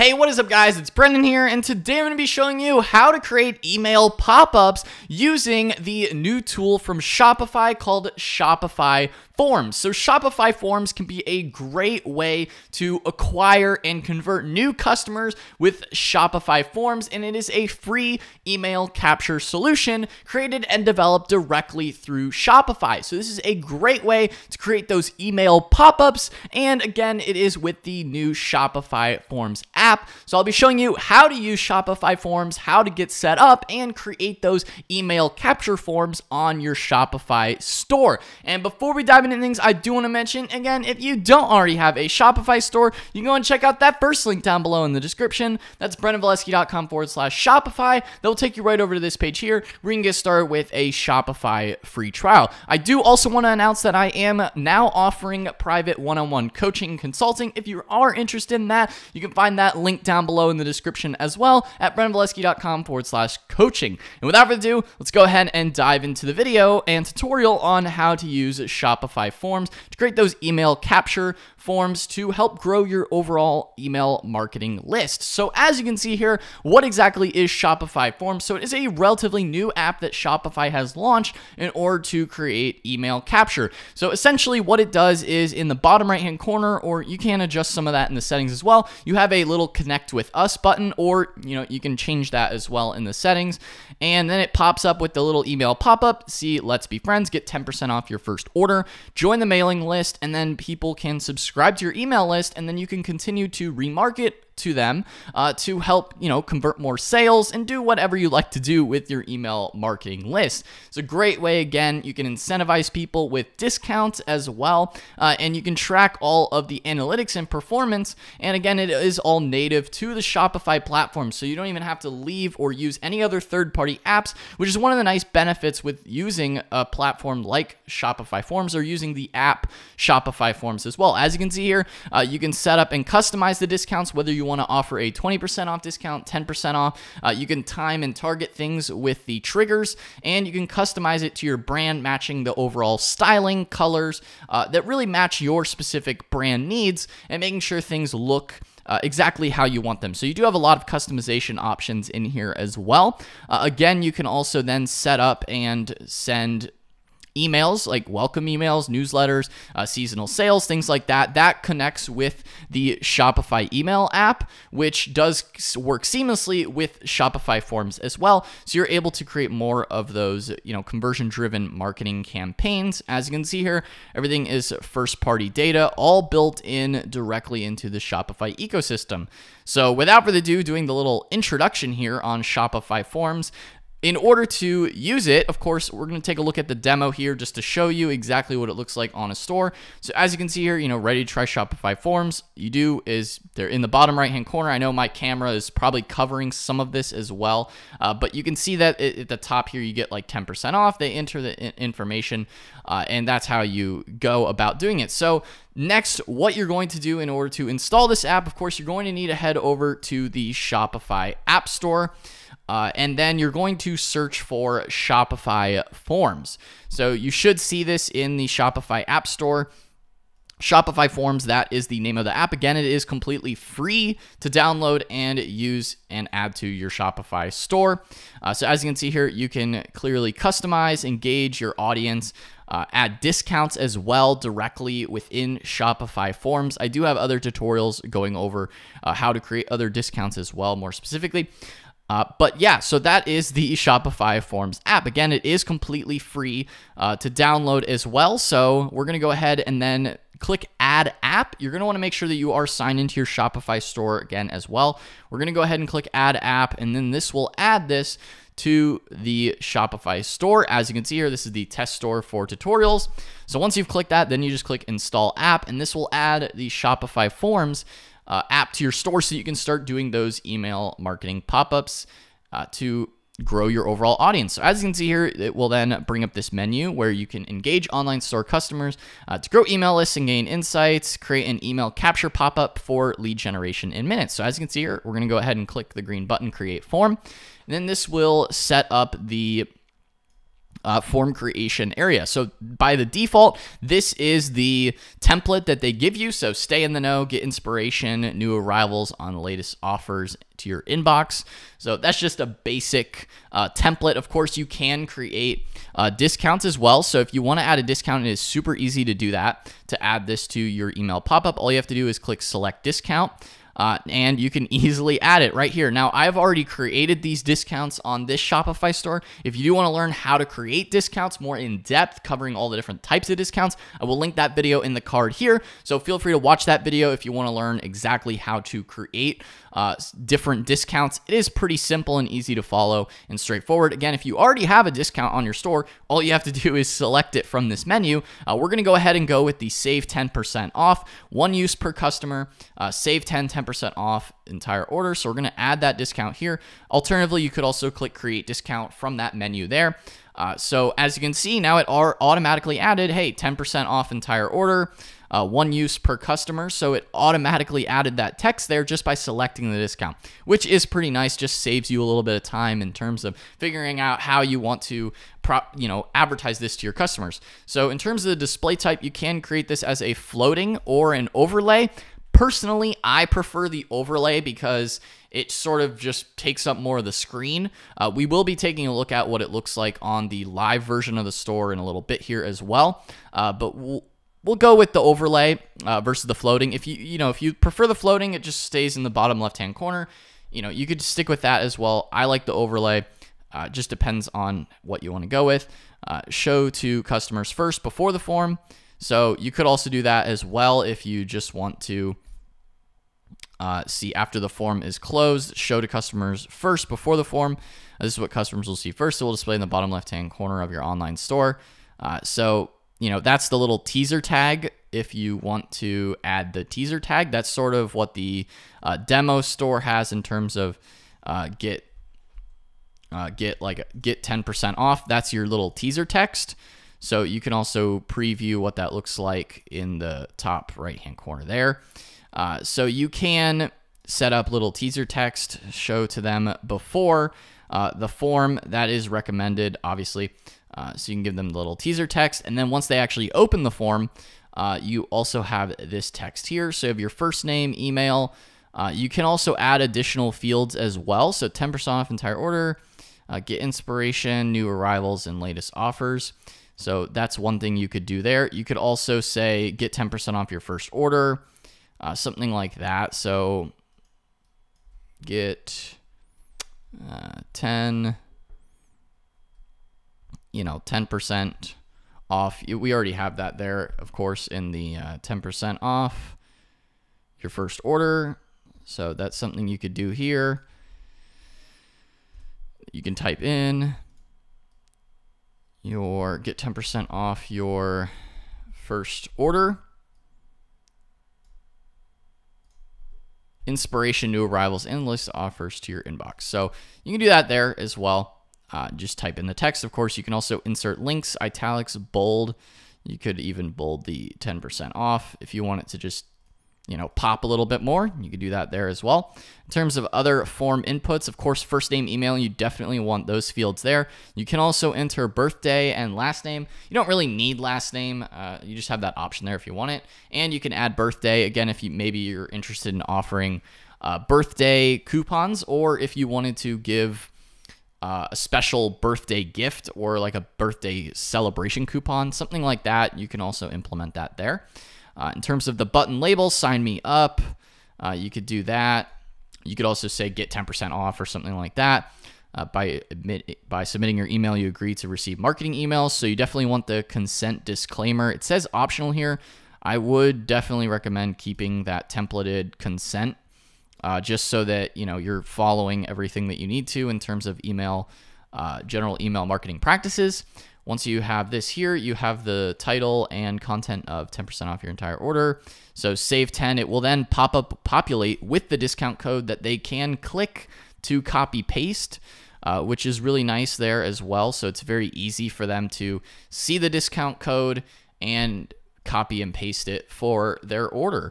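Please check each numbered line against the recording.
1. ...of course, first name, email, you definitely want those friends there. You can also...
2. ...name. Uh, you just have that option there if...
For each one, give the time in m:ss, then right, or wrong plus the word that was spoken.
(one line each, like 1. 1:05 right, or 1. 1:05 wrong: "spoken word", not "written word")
1. 8:31 wrong: "fields", not "friends"
2. 8:37 right.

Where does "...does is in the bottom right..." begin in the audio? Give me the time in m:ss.
1:24.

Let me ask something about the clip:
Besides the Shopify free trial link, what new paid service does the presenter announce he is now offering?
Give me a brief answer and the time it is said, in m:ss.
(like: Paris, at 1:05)
one on one coaching, at 0:55.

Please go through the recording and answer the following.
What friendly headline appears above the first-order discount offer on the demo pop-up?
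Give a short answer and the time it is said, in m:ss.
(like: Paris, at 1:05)
let's be friends, at 1:36.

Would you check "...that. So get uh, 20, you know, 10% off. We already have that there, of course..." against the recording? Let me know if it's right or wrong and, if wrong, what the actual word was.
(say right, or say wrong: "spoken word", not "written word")
wrong: "10", not "20".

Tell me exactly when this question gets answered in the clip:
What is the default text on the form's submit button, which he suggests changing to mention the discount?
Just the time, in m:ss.
8:56.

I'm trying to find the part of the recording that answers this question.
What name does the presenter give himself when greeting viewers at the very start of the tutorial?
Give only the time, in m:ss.
0:00.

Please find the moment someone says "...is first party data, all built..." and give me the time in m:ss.
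2:54.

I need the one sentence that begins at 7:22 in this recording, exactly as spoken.
And then once they actually open the form, uh, you also have this text here.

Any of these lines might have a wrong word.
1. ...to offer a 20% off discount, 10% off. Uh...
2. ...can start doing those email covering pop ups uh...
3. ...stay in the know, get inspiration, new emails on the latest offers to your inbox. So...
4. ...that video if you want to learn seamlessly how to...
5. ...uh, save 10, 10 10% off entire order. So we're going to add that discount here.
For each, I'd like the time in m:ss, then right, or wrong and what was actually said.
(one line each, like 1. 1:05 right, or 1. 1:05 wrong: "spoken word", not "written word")
1. 2:14 right
2. 4:29 wrong: "marketing", not "covering"
3. 4:56 wrong: "arrivals", not "emails"
4. 5:26 wrong: "exactly", not "seamlessly"
5. 5:42 right.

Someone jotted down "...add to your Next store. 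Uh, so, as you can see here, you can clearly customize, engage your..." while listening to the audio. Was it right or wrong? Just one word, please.
wrong.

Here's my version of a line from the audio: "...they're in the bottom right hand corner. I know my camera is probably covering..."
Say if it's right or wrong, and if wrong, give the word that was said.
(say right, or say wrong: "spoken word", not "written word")
right.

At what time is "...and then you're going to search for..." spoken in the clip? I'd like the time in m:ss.
3:32.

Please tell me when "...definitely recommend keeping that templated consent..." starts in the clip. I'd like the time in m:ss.
9:10.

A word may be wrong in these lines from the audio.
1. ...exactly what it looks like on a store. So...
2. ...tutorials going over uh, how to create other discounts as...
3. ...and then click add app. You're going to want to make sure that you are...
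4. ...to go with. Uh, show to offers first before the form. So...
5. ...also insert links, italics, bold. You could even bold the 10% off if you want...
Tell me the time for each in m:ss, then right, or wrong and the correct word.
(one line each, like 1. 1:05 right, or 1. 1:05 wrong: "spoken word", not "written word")
1. 3:08 right
2. 3:57 right
3. 4:09 right
4. 6:35 wrong: "customers", not "offers"
5. 8:20 right.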